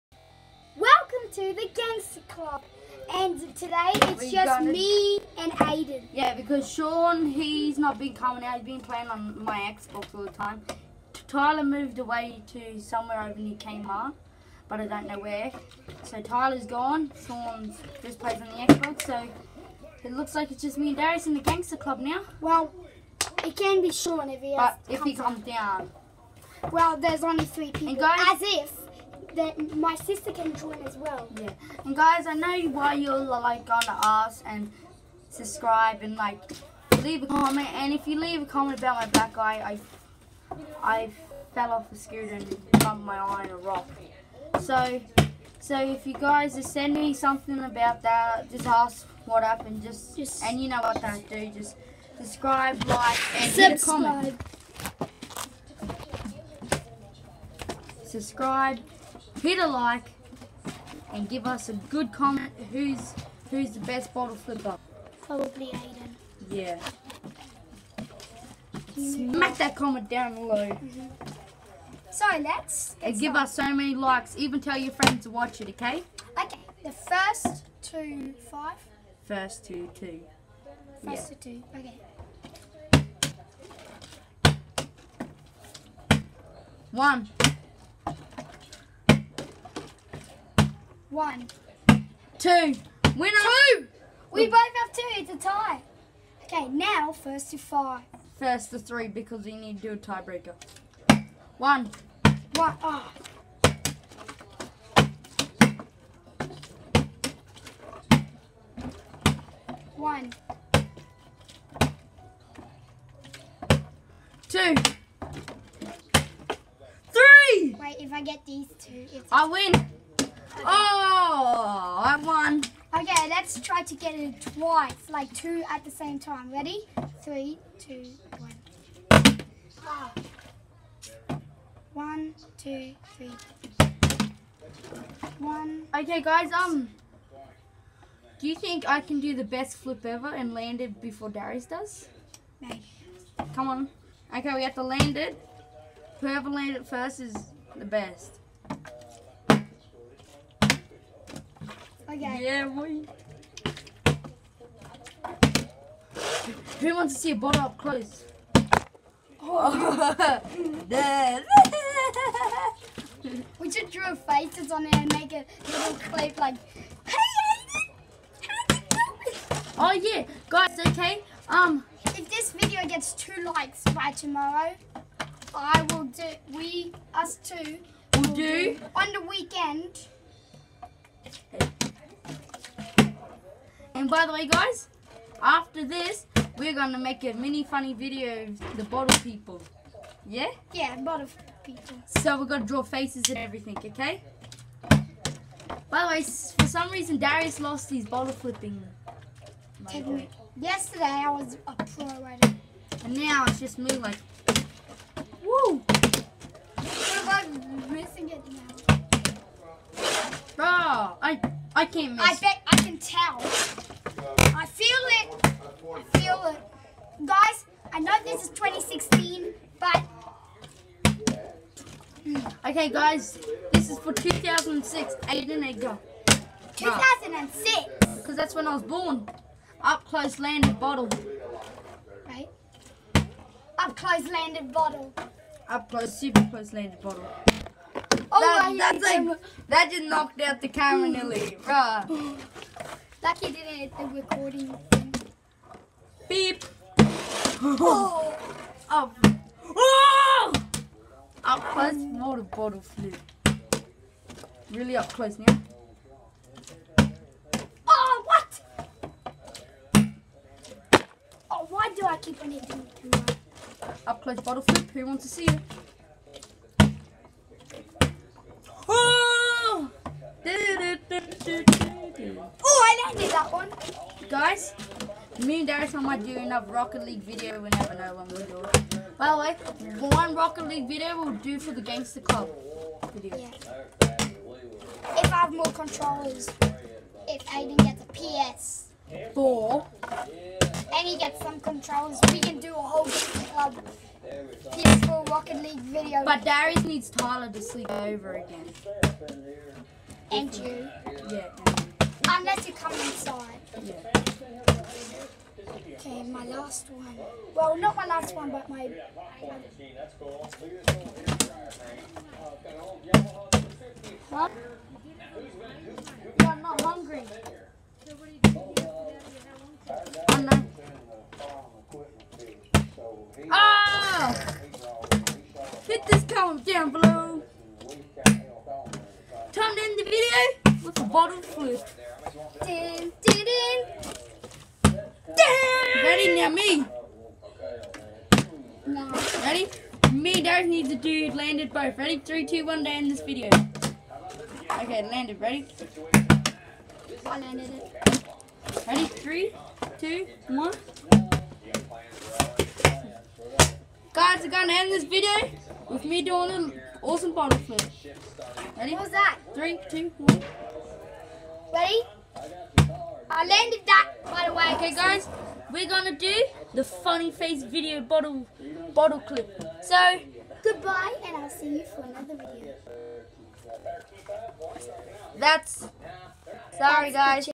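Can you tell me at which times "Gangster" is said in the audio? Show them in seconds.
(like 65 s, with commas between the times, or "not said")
1 s, 21 s, 281 s.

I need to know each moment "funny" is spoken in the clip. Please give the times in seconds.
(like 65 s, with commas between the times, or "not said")
187 s, 366 s.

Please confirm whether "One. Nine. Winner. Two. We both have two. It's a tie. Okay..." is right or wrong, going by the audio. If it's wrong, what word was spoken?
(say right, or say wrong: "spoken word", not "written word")
wrong: "Two", not "Nine".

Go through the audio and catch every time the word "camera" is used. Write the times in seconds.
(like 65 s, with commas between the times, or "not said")
240 s.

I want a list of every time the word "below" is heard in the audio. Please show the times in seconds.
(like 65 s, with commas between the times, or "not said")
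70 s, 326 s.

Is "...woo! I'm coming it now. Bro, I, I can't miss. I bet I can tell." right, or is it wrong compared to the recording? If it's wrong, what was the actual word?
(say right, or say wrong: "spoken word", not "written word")
wrong: "missing", not "coming".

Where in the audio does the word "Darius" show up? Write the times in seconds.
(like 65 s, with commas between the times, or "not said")
20 s, 141 s, 197 s, 275 s, 296 s, 340 s.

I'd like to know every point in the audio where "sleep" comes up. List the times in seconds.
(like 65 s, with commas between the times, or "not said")
297 s.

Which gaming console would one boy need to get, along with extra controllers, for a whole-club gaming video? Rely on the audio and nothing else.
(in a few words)
PS4.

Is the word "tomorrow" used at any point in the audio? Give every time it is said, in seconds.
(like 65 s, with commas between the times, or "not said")
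174 s.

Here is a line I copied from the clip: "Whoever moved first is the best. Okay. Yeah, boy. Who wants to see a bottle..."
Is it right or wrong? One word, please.
wrong.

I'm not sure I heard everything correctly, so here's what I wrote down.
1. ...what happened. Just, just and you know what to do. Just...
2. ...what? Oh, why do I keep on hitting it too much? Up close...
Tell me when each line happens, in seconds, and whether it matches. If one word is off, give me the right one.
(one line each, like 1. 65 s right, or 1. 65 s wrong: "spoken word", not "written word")
1. 49 s right
2. 258 s right.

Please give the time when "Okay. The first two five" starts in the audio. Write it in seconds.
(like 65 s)
76 s.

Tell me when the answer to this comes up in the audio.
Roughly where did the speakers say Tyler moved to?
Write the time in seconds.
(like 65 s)
13 s.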